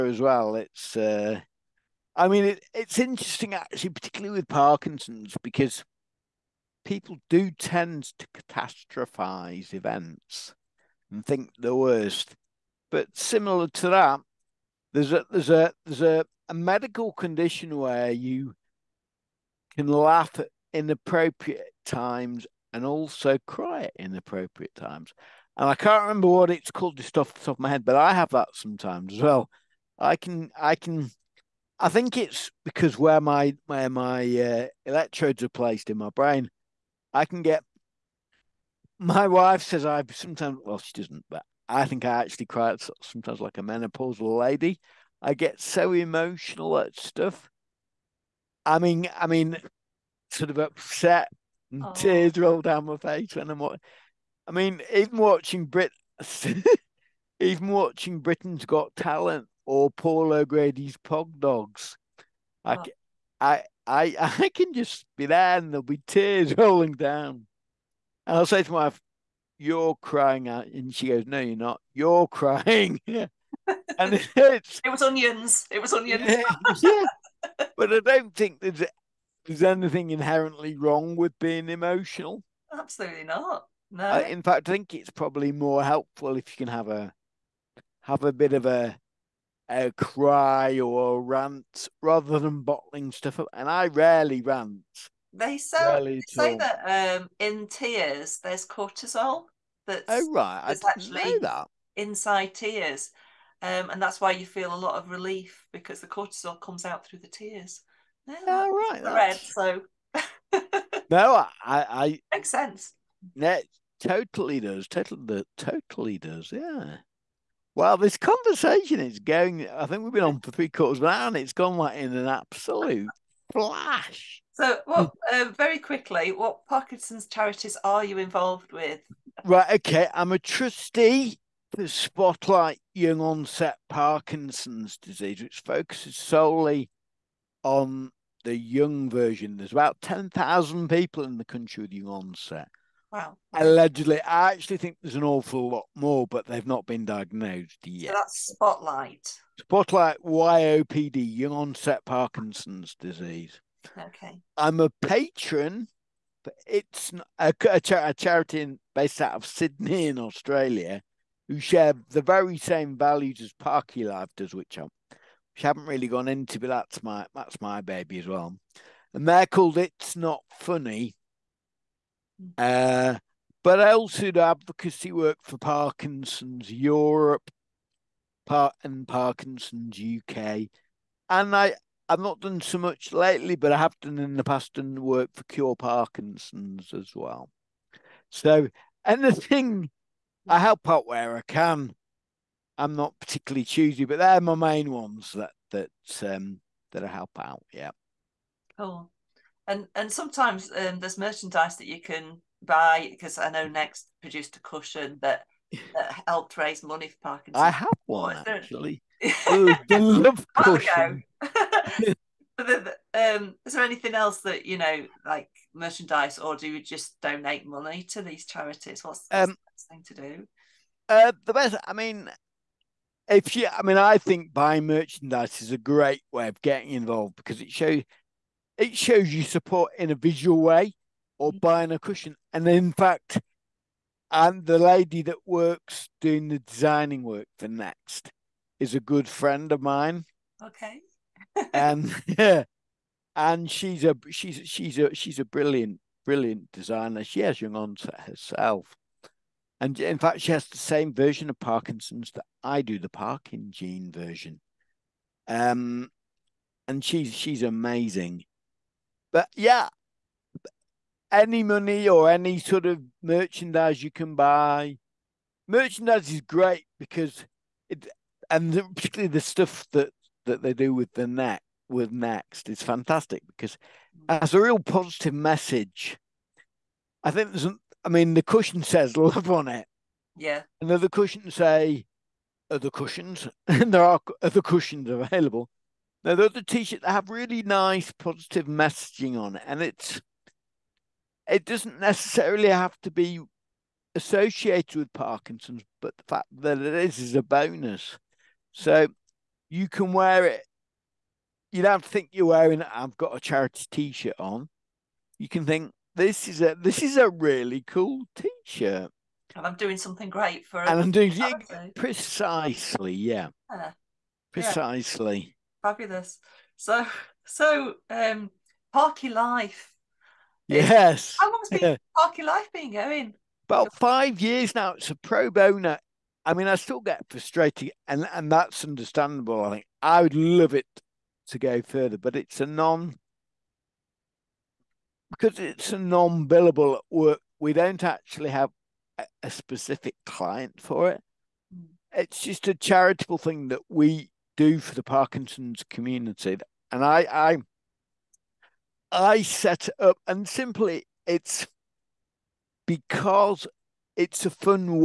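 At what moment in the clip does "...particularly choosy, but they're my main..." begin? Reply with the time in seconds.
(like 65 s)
193 s.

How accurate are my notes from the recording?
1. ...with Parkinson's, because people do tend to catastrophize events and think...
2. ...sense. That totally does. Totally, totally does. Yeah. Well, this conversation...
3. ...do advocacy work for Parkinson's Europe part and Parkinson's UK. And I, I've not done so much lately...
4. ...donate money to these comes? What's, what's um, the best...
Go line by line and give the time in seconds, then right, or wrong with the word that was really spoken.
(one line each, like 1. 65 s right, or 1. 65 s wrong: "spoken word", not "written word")
1. 4 s right
2. 112 s right
3. 174 s right
4. 217 s wrong: "charities", not "comes".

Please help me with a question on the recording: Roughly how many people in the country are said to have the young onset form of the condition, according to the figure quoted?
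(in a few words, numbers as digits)
10,000.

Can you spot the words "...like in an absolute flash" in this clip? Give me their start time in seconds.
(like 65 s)
121 s.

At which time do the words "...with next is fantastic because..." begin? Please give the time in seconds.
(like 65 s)
271 s.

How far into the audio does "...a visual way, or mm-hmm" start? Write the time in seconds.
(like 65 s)
230 s.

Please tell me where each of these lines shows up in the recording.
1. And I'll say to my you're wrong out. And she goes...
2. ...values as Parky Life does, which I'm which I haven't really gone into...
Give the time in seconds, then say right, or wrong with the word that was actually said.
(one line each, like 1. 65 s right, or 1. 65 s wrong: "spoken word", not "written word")
1. 68 s wrong: "crying", not "wrong"
2. 162 s right.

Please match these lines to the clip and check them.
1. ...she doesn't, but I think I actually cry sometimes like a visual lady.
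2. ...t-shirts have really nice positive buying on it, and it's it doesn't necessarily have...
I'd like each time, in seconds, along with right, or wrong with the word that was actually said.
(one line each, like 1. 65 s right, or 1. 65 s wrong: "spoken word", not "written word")
1. 40 s wrong: "menopausal", not "visual"
2. 286 s wrong: "messaging", not "buying".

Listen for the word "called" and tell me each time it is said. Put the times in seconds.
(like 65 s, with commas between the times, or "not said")
26 s, 169 s.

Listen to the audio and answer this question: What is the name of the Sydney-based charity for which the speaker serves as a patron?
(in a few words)
It's Not Funny.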